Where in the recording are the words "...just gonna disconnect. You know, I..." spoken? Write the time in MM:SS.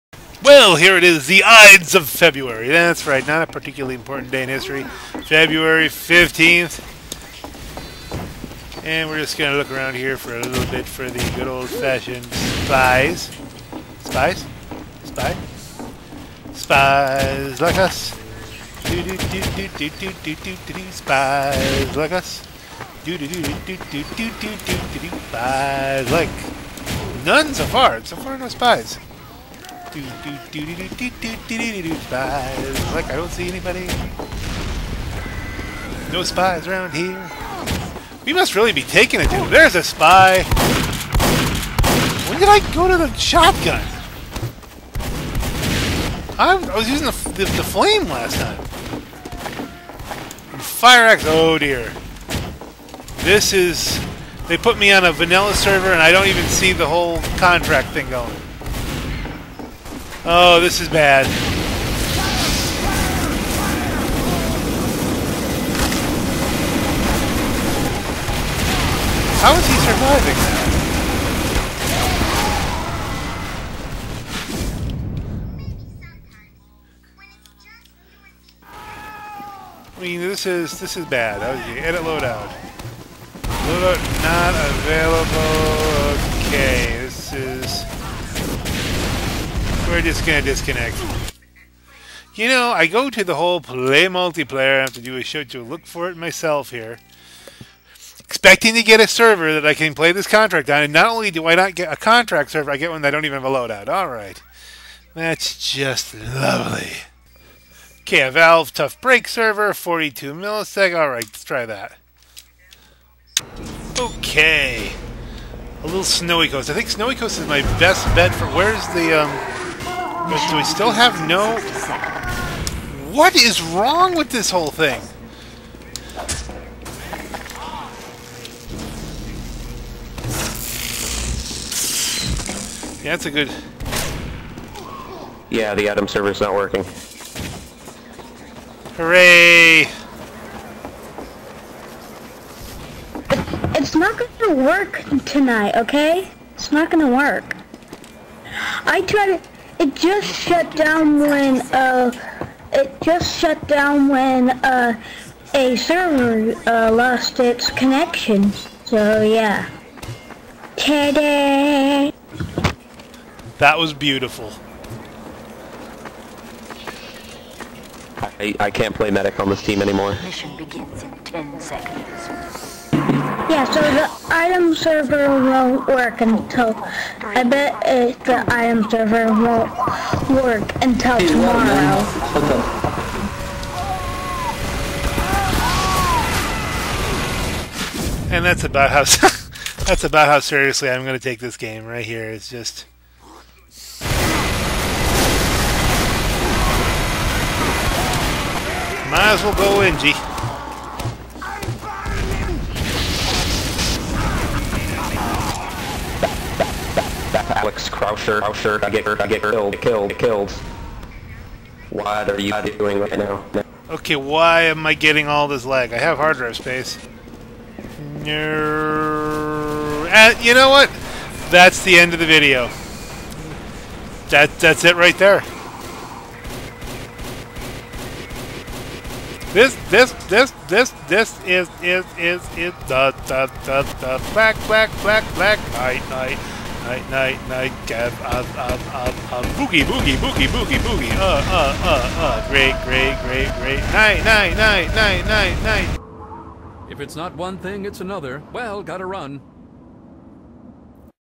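01:30.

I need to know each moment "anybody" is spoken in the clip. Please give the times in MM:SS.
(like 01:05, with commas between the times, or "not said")
00:33.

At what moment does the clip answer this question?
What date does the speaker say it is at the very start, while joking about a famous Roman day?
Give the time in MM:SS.
00:05.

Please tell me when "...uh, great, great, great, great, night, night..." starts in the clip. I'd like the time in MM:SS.
04:02.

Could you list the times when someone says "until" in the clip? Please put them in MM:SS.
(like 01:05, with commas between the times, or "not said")
02:56, 03:00.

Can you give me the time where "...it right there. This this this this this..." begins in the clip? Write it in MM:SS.
03:44.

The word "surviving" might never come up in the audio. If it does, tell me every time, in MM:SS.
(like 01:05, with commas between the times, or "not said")
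01:09.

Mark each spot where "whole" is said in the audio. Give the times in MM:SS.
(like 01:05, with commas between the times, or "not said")
00:56, 01:33, 02:04.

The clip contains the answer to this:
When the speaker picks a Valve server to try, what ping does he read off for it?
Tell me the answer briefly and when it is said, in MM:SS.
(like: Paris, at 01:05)
42 milliseconds, at 01:49.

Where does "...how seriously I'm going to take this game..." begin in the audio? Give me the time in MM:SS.
03:10.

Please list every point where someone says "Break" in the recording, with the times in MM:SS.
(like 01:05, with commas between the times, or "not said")
01:49.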